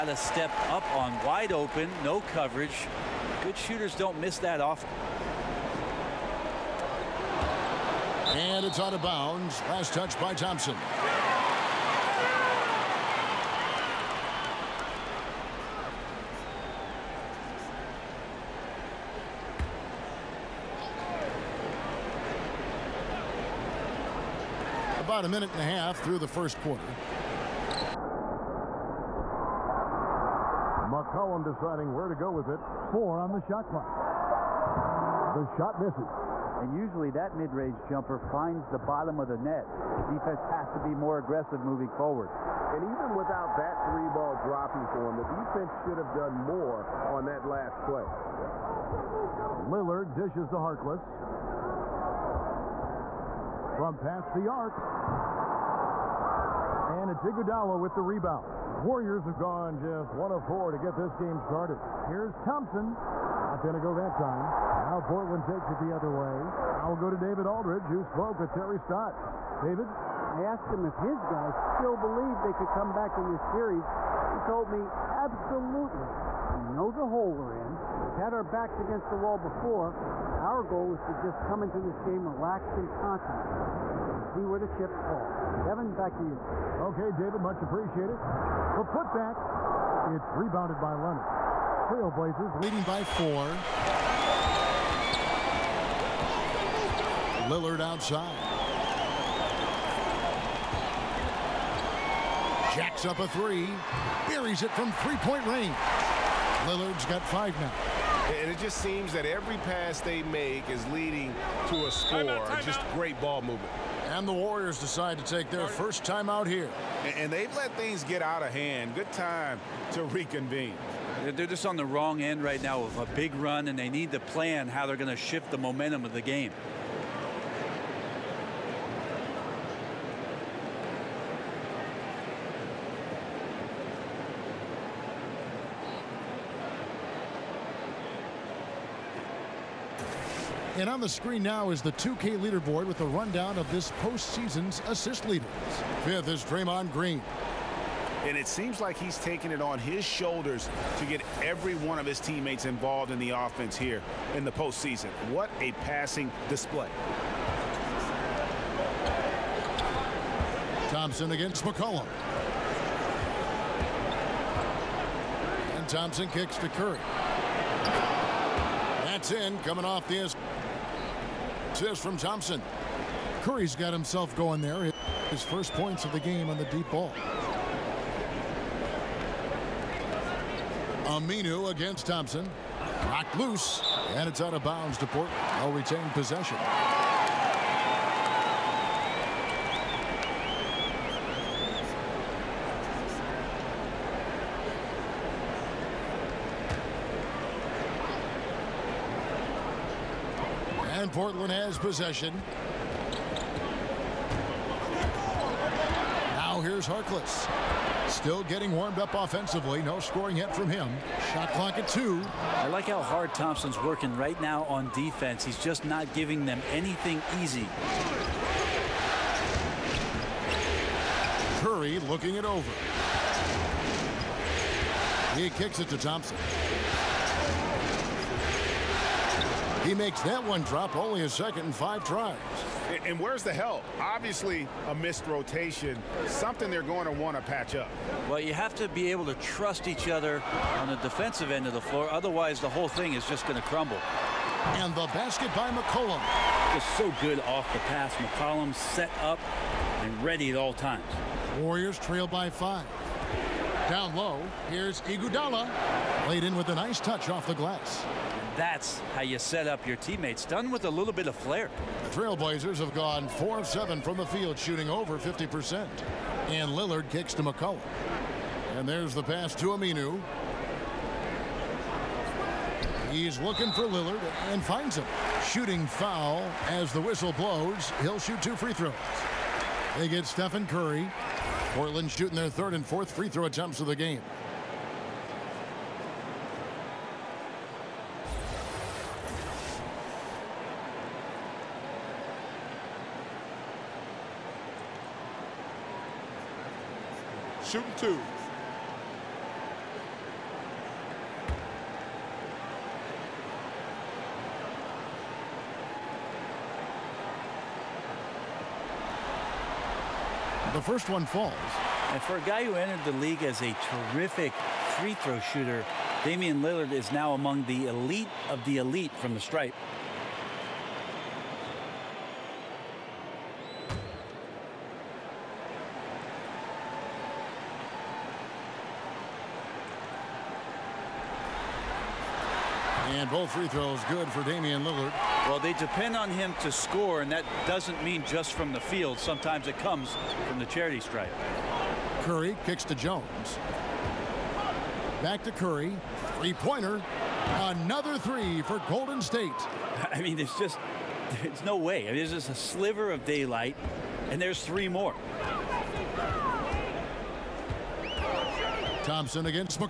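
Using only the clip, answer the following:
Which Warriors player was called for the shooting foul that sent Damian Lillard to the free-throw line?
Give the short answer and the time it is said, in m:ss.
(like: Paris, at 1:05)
Stephen Curry, at 4:40.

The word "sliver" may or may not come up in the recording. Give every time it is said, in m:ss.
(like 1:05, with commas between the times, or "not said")
5:52.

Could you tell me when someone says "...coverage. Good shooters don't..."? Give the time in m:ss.
0:02.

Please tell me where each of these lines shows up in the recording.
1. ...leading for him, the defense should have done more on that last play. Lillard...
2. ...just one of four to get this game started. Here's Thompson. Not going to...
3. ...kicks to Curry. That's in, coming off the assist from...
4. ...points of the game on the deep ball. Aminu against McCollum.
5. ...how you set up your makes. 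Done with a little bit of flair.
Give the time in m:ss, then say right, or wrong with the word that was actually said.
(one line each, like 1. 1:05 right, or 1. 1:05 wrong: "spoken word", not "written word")
1. 0:44 wrong: "dropping", not "leading"
2. 0:59 right
3. 2:46 right
4. 2:55 wrong: "Thompson", not "McCollum"
5. 4:19 wrong: "teammates", not "makes".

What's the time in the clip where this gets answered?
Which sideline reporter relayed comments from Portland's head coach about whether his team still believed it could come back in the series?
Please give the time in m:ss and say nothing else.
1:07.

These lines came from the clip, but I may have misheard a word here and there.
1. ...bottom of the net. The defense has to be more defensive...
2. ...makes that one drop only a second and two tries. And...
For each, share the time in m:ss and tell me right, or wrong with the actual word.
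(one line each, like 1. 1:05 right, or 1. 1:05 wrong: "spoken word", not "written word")
1. 0:38 wrong: "aggressive", not "defensive"
2. 3:49 wrong: "five", not "two".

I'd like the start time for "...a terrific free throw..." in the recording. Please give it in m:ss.
5:13.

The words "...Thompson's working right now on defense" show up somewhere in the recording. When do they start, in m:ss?
3:33.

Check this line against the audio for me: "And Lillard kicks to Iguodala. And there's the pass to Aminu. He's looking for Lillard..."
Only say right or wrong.
wrong.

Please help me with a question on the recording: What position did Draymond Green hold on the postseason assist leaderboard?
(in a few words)
Fifth.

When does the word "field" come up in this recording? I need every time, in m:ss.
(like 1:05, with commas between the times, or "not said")
4:24, 5:38.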